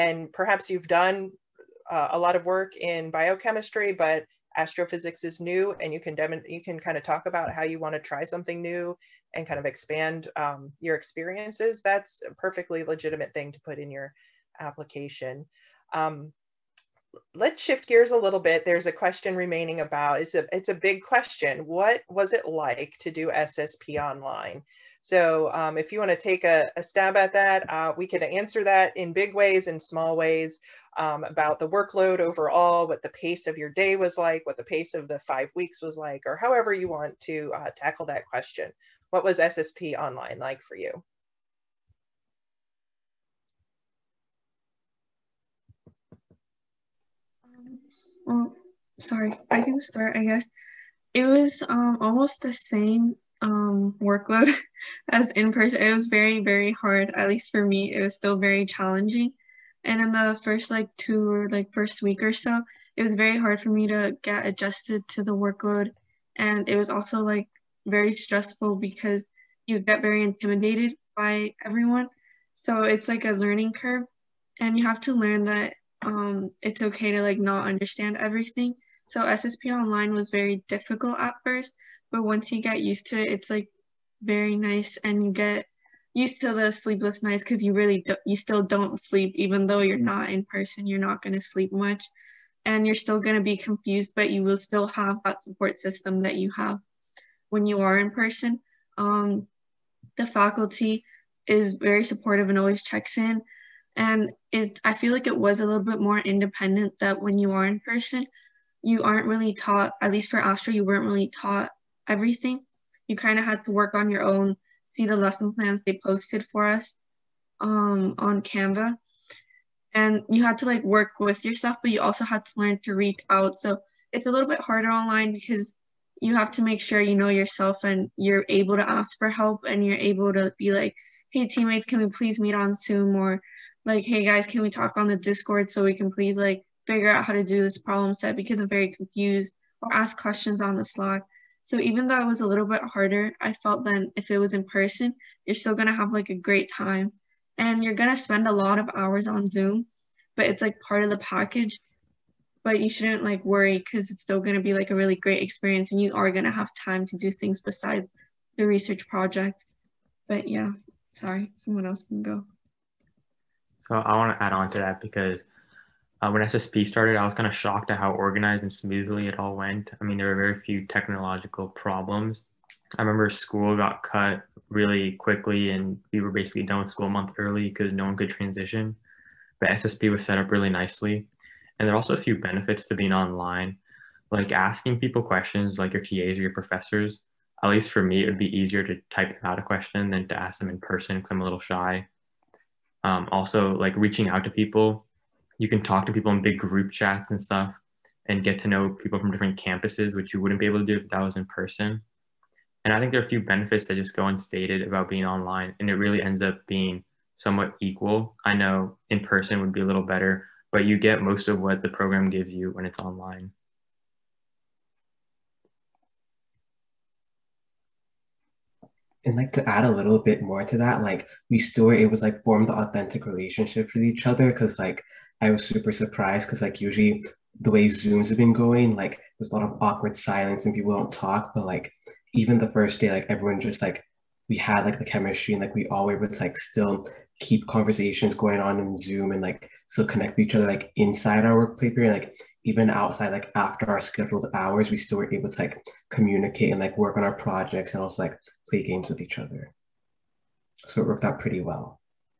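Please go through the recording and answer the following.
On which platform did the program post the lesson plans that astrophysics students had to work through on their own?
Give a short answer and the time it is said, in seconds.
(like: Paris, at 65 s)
Canva, at 118 s.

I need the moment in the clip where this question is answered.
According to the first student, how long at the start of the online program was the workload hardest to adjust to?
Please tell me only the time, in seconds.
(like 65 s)
61 s.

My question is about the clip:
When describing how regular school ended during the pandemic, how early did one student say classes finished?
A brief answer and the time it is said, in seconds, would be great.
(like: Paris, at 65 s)
a month early, at 177 s.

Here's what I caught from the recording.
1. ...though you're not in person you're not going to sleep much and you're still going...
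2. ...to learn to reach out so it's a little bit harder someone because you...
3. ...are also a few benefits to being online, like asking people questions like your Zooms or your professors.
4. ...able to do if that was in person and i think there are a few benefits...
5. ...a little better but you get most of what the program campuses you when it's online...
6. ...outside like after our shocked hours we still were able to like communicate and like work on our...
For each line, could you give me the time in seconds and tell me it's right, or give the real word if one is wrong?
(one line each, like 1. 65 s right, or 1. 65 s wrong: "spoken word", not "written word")
1. 89 s right
2. 122 s wrong: "online", not "someone"
3. 181 s wrong: "TAs", not "Zooms"
4. 200 s right
5. 209 s wrong: "gives", not "campuses"
6. 242 s wrong: "scheduled", not "shocked".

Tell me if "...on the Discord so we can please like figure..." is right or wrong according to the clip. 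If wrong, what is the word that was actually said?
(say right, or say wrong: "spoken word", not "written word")
right.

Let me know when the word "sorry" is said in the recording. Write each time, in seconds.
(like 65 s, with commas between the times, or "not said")
49 s, 161 s.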